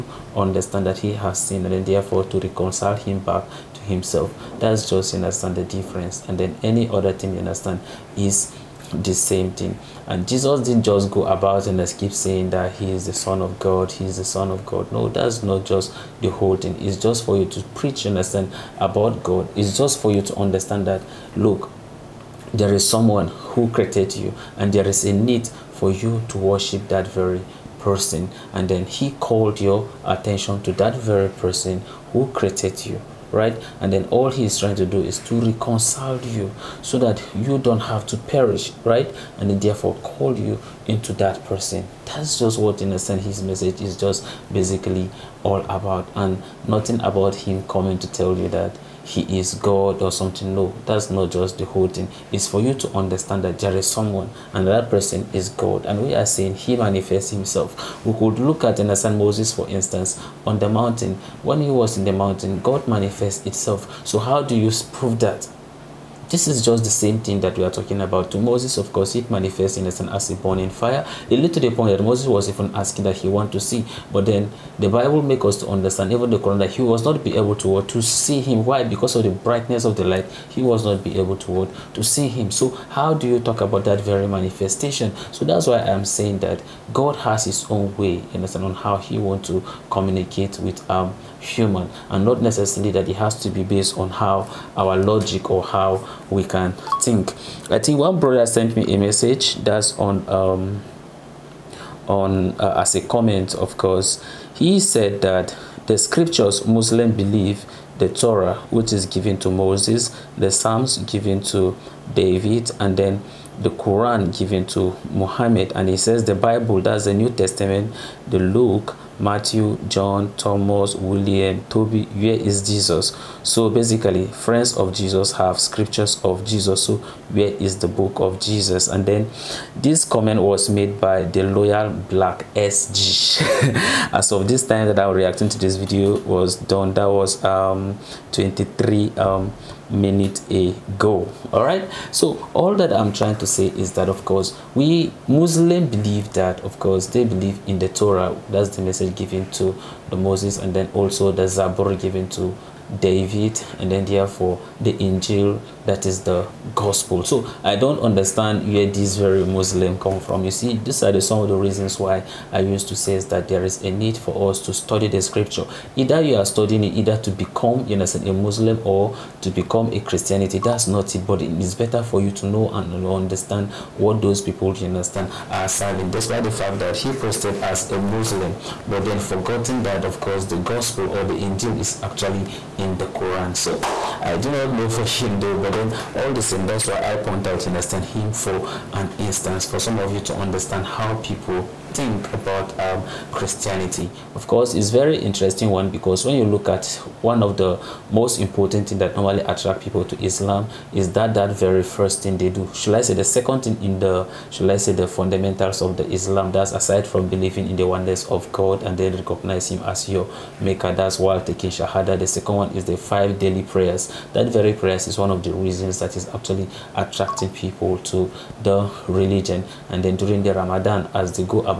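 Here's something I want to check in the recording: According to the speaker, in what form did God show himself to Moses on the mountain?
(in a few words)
burning fire.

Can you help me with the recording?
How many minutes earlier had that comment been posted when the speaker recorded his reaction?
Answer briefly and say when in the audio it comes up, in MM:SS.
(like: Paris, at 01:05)
23, at 02:18.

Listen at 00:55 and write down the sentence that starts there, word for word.
And we are saying he manifests himself.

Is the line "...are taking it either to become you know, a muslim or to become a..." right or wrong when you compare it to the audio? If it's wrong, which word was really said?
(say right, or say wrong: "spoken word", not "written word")
wrong: "studying", not "taking".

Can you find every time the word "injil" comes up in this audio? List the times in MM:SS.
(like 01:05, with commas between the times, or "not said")
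02:34, 03:01.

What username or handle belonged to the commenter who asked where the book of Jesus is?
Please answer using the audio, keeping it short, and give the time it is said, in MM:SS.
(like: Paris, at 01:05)
loyal black SG, at 02:11.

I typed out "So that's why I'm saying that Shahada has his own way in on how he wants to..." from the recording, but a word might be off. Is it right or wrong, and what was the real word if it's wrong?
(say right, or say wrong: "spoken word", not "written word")
wrong: "God", not "Shahada".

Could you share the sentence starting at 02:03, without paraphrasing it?
So basically, friends of Jesus have scriptures of Jesus.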